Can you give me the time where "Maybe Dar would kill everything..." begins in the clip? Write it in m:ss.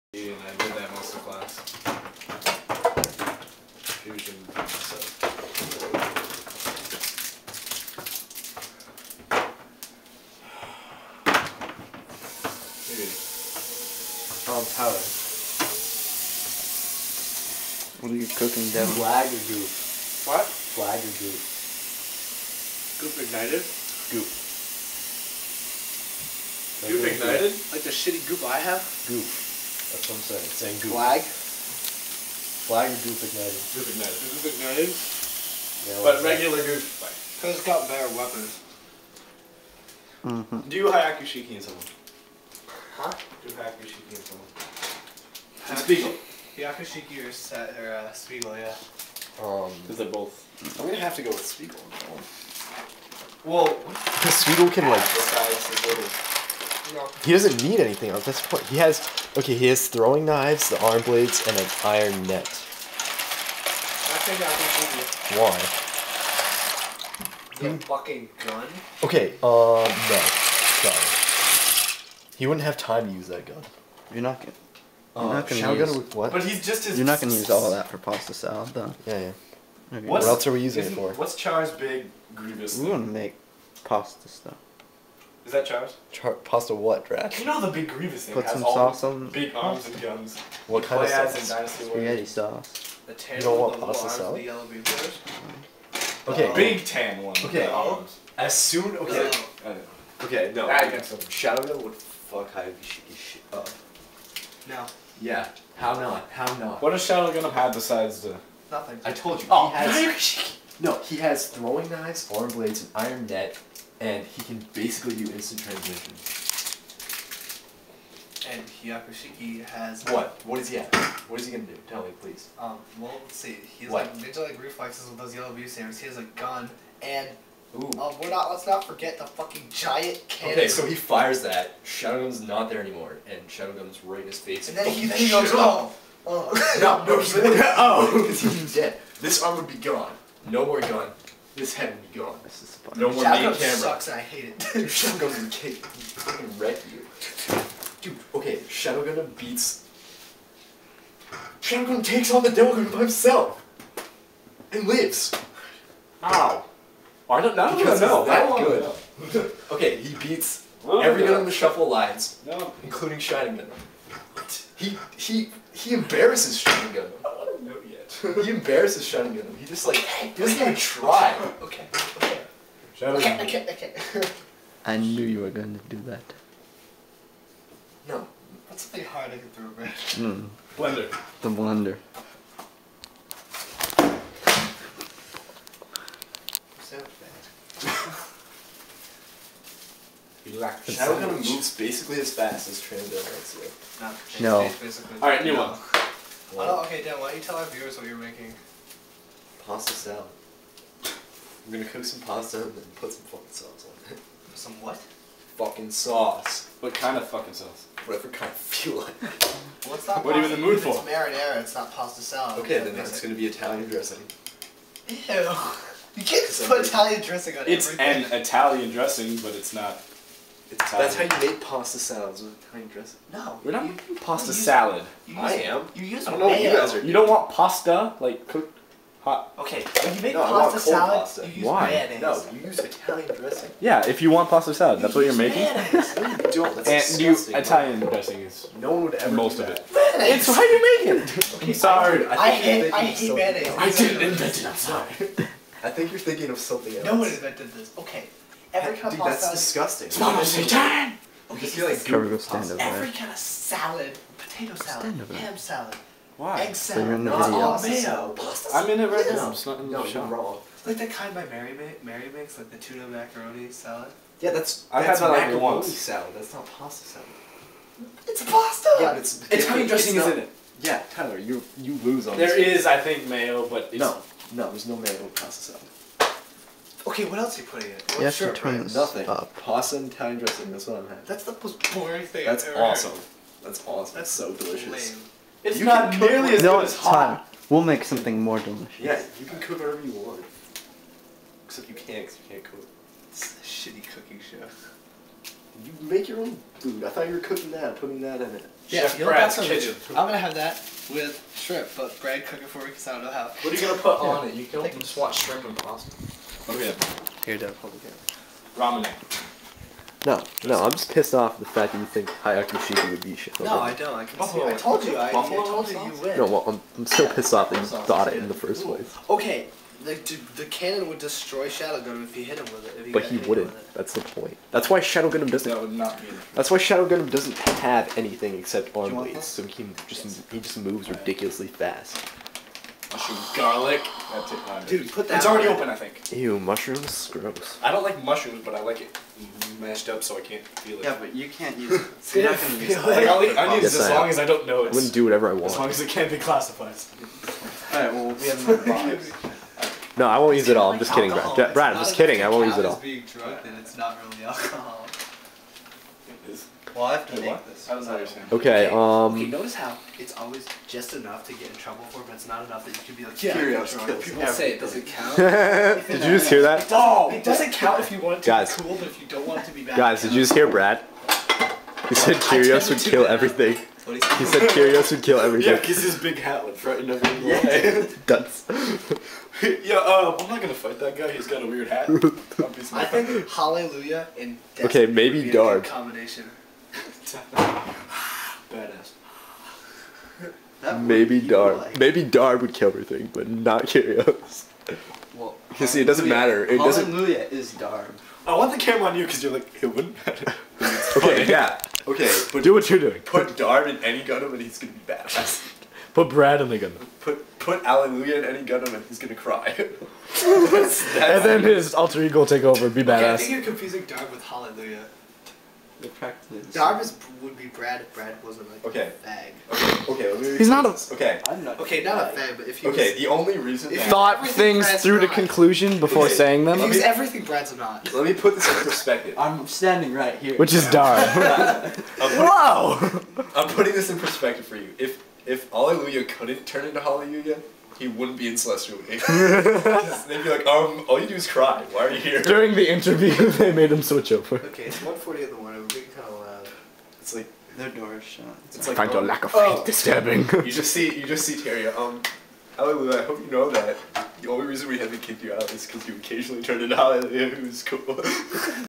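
6:31.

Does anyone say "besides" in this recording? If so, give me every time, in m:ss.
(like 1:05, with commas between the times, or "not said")
1:47.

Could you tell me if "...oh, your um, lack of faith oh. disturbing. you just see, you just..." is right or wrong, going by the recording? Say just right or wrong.
right.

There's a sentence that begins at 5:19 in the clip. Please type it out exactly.
Okay, the, the cannon would destroy Shadow Gundam if he hit him with it.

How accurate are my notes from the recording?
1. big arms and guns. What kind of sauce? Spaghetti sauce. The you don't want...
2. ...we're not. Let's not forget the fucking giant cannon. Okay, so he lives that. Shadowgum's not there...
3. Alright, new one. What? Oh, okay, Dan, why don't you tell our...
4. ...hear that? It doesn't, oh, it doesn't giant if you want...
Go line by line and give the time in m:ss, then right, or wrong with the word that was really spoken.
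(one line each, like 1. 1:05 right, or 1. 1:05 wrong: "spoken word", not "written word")
1. 1:29 right
2. 2:08 wrong: "fires", not "lives"
3. 3:15 right
4. 6:06 wrong: "count", not "giant".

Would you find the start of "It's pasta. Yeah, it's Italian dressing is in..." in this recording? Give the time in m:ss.
4:28.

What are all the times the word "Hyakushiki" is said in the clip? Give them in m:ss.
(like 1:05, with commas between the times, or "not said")
1:42, 1:58.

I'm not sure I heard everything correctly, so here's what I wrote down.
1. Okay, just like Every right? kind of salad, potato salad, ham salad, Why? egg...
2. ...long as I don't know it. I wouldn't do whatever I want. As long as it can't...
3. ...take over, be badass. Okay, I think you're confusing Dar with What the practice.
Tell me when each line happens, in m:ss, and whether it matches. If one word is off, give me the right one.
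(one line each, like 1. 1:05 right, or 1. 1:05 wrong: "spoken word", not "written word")
1. 4:11 right
2. 5:44 right
3. 6:52 wrong: "Hallelujah", not "What".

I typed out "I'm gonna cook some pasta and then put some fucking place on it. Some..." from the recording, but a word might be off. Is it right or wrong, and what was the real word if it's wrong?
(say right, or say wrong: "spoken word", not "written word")
wrong: "sauce", not "place".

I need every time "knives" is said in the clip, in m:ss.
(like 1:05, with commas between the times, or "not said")
1:00, 1:51.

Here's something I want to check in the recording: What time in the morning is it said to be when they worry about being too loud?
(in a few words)
1:40.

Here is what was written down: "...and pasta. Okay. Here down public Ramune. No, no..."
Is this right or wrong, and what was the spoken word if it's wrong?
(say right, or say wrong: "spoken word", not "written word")
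right.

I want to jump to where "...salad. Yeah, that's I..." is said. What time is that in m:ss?
4:23.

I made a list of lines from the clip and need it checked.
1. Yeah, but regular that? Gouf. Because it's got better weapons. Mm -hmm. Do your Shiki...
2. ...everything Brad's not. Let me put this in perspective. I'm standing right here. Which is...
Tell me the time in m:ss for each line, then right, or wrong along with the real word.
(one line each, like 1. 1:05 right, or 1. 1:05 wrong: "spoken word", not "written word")
1. 0:34 right
2. 7:07 right.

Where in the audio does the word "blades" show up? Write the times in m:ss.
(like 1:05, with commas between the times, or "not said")
1:01, 1:52, 5:29.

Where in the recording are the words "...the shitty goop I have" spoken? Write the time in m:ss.
0:27.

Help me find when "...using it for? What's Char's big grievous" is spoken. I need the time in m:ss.
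1:20.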